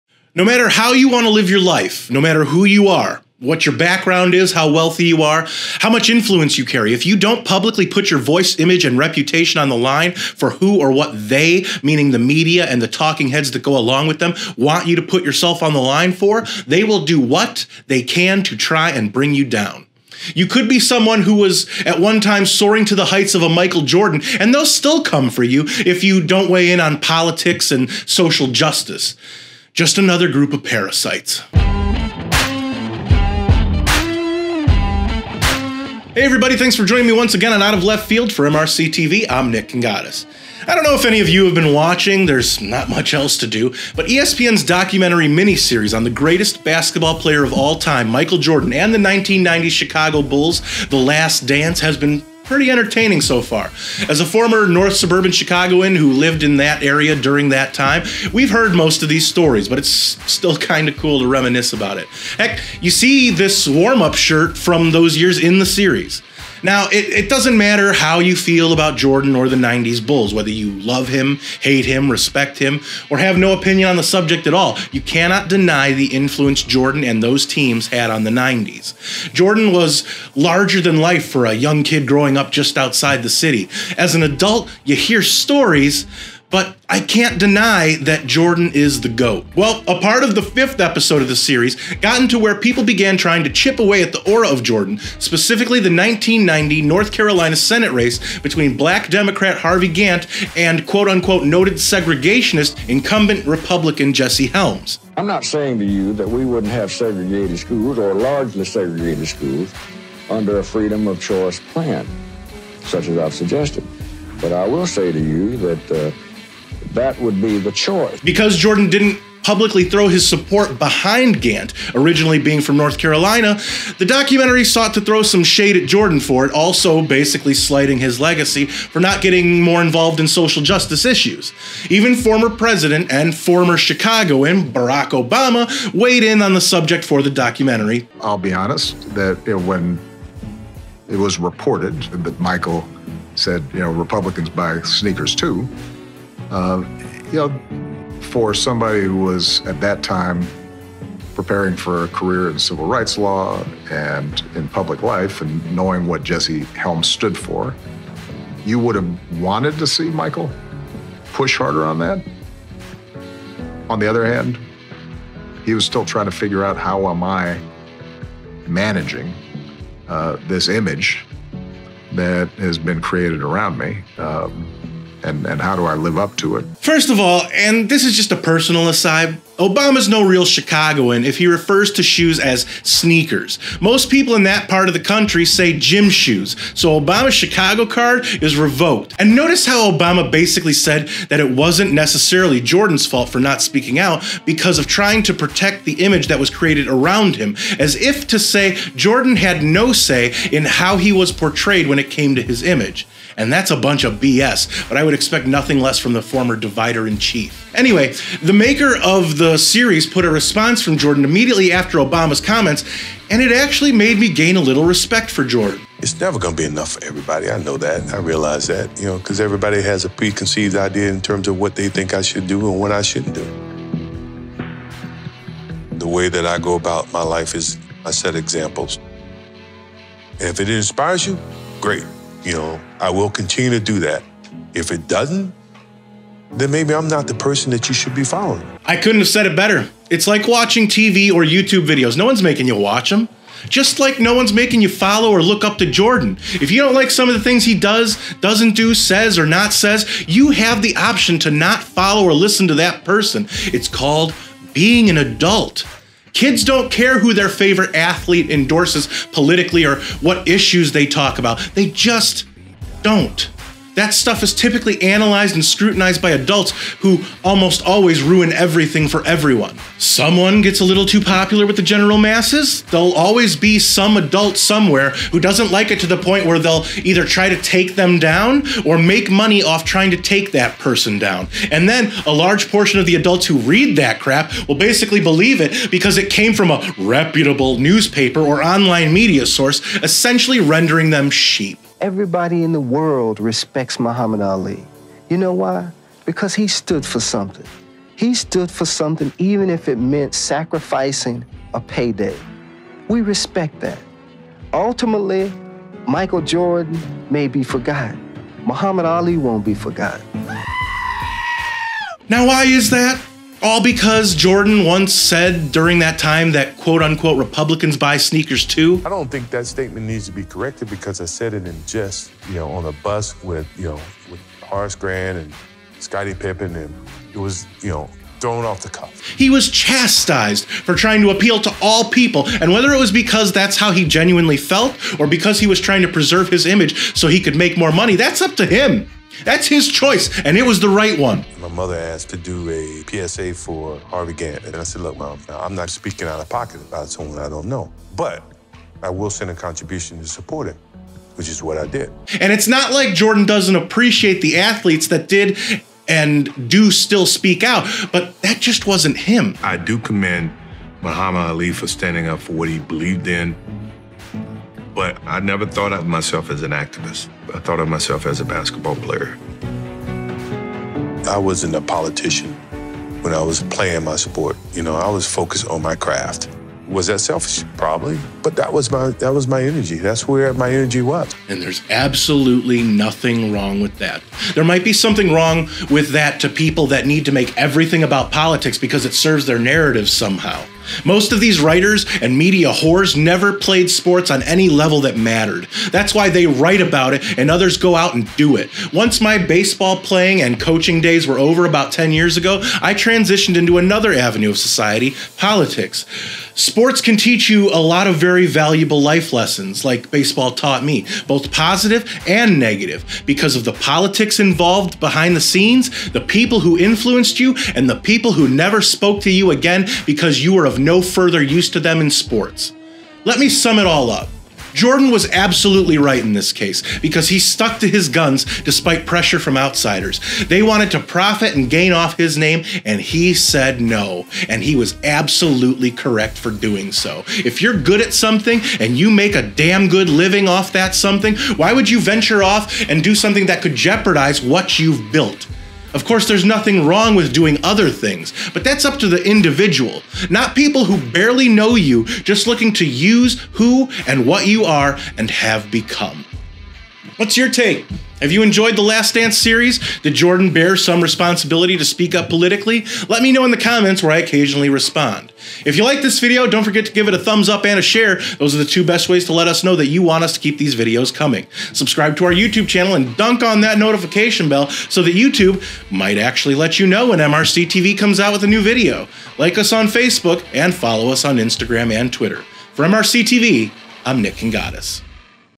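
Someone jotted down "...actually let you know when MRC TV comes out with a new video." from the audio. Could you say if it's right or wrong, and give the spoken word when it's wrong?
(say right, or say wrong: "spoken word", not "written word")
right.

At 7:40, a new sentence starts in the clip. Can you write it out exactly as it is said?
Did Jordan bear some responsibility to speak up politically?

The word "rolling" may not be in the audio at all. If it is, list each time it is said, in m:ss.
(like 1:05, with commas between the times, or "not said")
not said.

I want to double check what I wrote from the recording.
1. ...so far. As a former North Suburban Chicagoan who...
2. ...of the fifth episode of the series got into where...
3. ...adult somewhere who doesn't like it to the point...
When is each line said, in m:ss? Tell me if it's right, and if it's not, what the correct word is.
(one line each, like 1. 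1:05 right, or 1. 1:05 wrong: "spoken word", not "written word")
1. 0:53 right
2. 1:30 right
3. 4:34 right.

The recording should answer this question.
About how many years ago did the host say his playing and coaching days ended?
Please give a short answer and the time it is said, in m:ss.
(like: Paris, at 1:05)
10 years, at 6:41.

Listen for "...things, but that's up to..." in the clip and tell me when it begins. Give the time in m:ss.
7:27.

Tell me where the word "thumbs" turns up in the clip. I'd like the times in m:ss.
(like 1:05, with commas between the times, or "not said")
7:47.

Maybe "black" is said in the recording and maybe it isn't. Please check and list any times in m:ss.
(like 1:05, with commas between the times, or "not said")
1:38.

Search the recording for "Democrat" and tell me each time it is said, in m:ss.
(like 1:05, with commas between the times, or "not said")
1:39.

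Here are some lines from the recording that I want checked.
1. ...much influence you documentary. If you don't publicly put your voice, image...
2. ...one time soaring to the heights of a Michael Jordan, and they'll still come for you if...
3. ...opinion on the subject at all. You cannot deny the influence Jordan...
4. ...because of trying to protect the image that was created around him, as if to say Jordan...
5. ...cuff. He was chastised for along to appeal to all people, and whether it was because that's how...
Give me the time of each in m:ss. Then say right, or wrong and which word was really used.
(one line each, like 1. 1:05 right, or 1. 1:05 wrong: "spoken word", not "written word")
1. 0:05 wrong: "carry", not "documentary"
2. 0:21 right
3. 1:13 right
4. 3:14 right
5. 5:28 wrong: "trying", not "along".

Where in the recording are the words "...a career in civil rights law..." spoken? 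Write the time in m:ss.
2:32.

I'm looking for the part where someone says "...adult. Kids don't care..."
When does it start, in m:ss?
4:15.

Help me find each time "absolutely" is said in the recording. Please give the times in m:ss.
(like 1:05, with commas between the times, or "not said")
6:21, 7:05, 7:15.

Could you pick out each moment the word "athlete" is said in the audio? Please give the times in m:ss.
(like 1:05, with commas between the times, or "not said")
4:17, 5:54.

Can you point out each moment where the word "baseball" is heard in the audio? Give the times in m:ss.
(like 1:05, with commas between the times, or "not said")
6:39, 6:50.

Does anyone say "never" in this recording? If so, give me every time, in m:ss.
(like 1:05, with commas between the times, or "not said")
3:36, 6:05, 6:33, 6:58.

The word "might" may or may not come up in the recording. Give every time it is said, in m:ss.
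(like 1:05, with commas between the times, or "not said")
6:24, 7:55.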